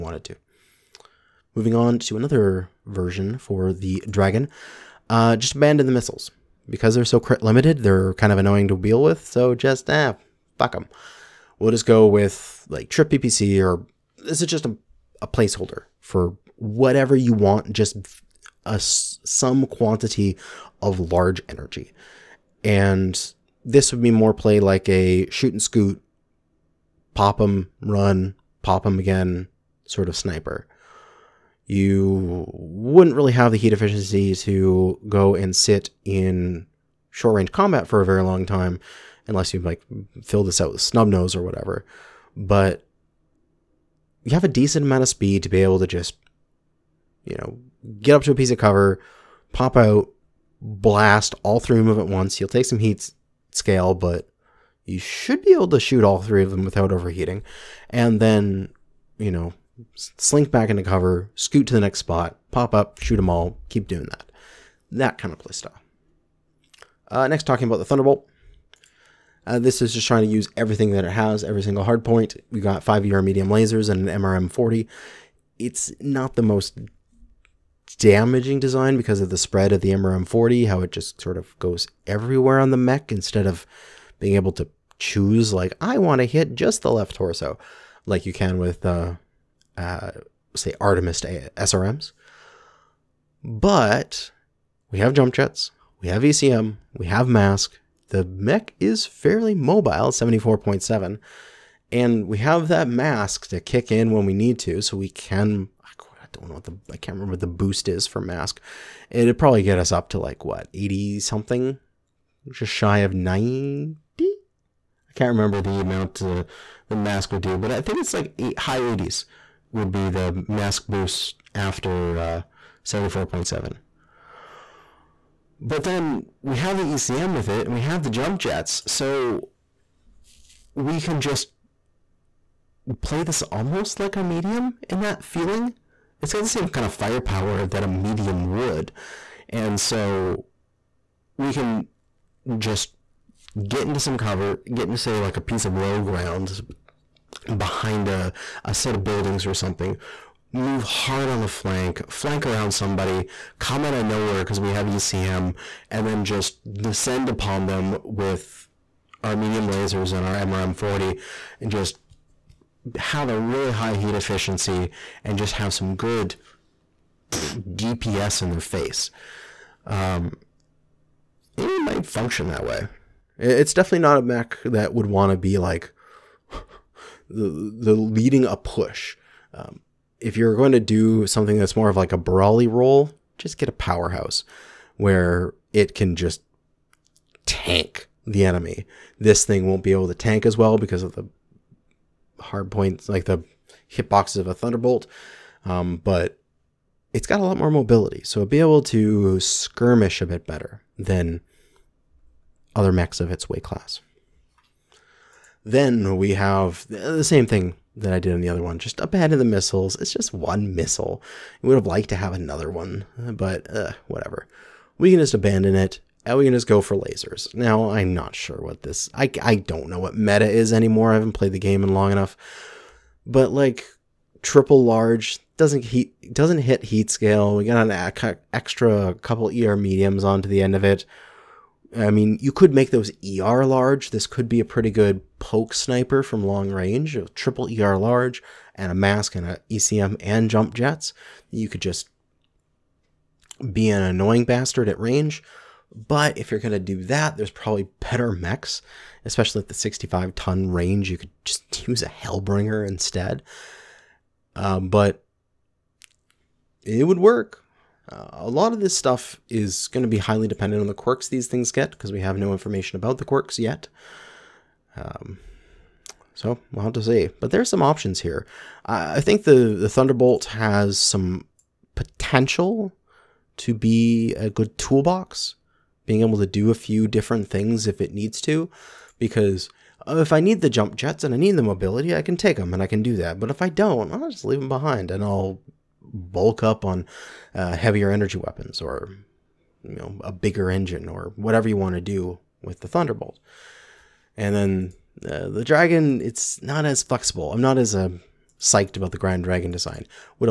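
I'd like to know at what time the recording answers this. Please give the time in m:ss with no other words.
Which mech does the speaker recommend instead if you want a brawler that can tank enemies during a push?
3:03.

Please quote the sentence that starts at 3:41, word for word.
I haven't played the game in long enough.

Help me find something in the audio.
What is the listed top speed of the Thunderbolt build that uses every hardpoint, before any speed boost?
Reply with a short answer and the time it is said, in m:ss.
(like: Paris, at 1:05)
74.7, at 1:40.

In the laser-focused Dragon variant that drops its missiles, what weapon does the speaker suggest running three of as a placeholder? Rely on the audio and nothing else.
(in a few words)
PPC.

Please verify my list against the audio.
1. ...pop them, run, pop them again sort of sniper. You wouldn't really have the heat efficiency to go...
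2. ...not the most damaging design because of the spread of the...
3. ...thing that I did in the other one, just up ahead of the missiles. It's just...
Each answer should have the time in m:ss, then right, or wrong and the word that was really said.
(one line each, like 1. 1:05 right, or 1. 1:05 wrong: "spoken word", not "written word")
1. 0:27 right
2. 1:16 right
3. 3:27 right.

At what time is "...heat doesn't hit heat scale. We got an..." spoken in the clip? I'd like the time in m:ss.
3:45.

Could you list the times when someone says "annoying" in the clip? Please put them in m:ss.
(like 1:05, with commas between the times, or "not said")
0:08, 4:04.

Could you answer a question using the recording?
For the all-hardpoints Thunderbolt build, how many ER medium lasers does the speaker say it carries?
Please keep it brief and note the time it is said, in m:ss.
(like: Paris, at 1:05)
5, at 1:12.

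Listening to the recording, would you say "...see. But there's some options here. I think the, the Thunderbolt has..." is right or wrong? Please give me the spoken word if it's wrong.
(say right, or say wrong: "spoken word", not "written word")
right.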